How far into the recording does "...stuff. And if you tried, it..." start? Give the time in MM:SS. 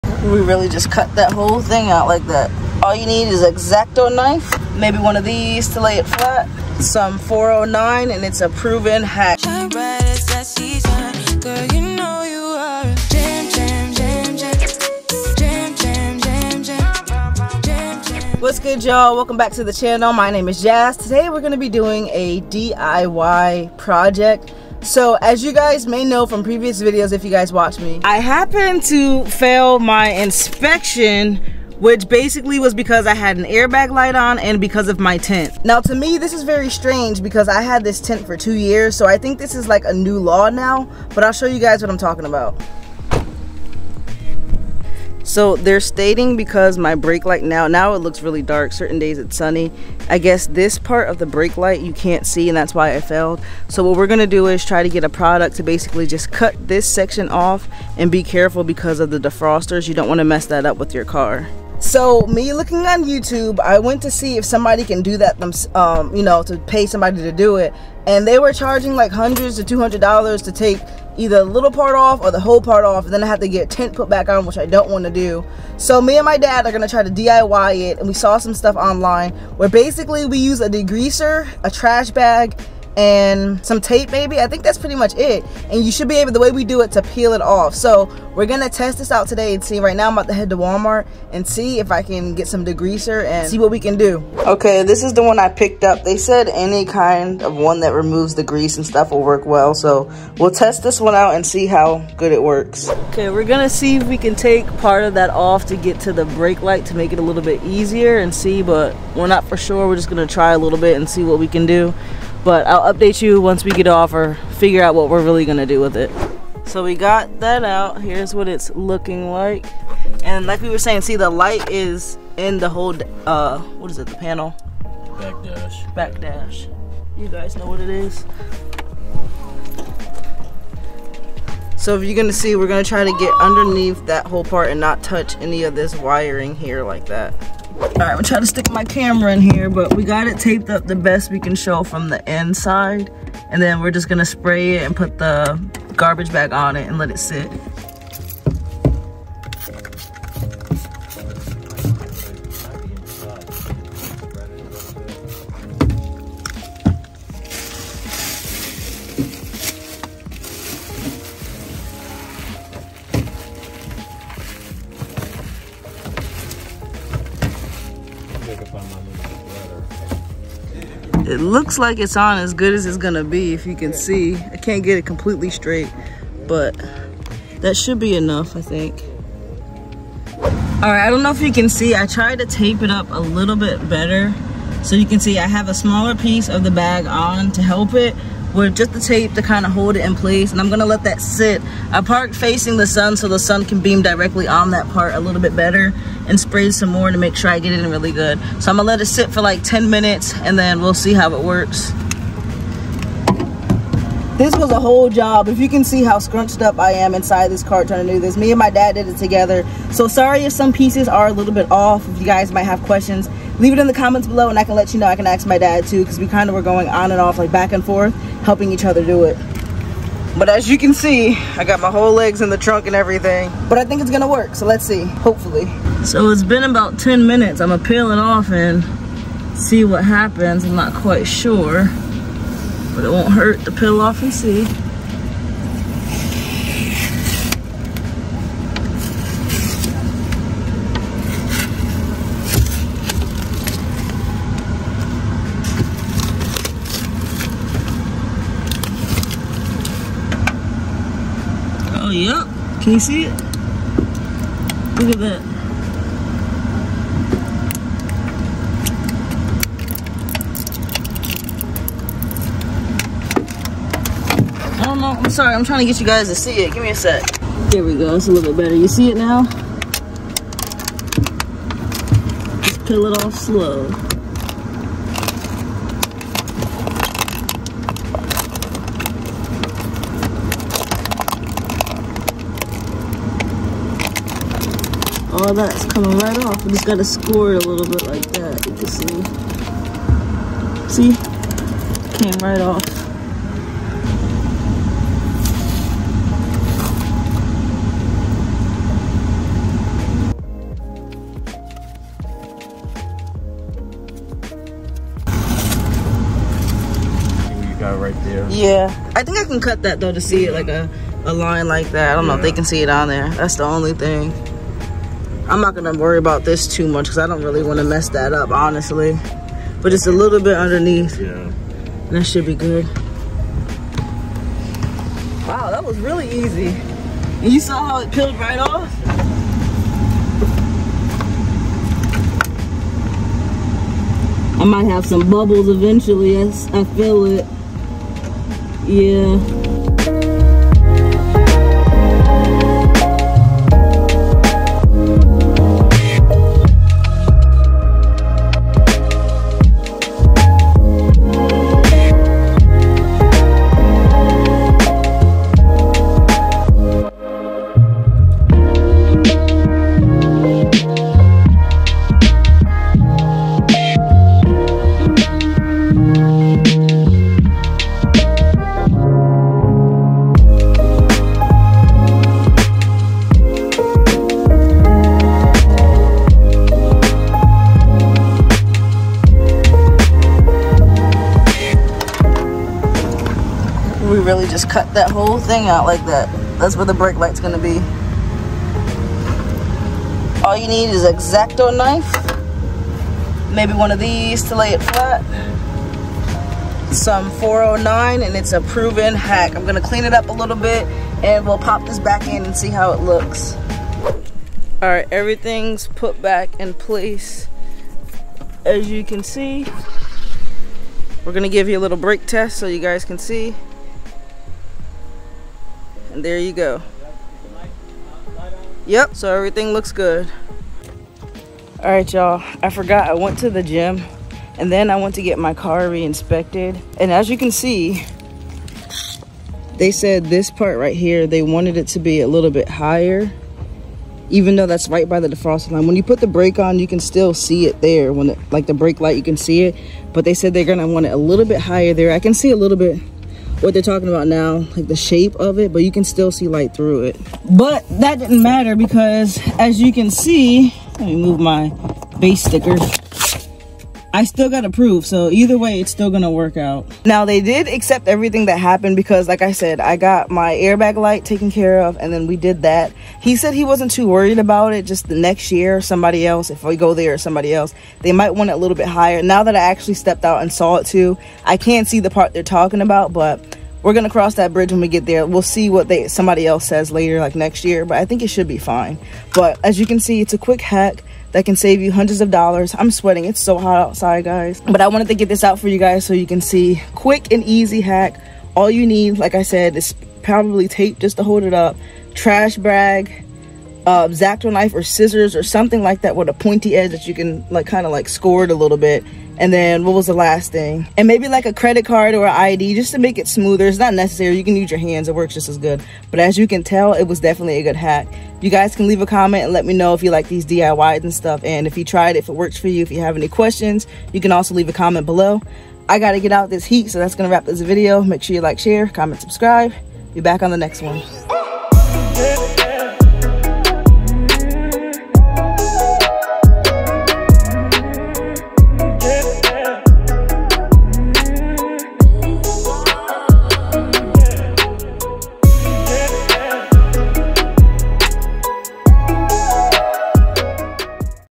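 08:31.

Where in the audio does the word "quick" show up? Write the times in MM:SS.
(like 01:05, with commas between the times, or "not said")
08:00, 08:06.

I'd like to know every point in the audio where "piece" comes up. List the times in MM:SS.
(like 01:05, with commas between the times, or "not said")
03:06, 03:30.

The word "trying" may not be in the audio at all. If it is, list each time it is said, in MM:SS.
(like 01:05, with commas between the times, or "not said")
02:18, 03:27, 04:25.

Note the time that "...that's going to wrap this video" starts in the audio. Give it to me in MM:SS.
08:36.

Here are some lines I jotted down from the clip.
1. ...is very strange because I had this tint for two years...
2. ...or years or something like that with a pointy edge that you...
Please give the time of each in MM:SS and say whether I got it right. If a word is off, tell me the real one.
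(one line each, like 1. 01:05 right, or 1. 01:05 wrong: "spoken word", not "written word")
1. 00:36 right
2. 08:14 wrong: "scissors", not "years".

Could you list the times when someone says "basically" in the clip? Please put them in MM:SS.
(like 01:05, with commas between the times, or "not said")
00:32, 00:55, 01:19.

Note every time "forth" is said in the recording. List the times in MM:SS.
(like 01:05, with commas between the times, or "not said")
03:37.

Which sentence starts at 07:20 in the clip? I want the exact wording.
But they said they're gonna want it a little bit higher there.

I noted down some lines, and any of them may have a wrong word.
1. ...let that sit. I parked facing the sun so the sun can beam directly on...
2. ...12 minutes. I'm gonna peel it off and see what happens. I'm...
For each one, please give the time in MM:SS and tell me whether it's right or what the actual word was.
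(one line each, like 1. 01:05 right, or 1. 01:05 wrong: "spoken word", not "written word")
1. 03:10 right
2. 03:46 wrong: "10", not "12".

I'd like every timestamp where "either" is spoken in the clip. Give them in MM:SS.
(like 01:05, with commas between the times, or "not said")
01:11, 07:35.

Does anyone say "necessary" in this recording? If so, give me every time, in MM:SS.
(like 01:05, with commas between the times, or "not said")
08:23.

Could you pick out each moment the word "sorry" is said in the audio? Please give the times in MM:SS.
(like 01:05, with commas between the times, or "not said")
03:30, 04:25.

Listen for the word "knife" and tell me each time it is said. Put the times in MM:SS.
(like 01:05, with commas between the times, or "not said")
00:04, 06:31, 08:14.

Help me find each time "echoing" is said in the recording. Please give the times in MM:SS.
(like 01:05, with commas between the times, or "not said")
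not said.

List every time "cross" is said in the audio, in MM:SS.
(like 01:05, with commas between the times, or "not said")
07:54.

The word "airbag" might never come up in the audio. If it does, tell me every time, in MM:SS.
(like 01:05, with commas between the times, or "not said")
00:33, 07:40.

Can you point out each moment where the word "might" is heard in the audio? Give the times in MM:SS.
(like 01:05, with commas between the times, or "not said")
03:32, 05:34, 07:48.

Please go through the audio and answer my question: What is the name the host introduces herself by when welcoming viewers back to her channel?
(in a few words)
Jazz.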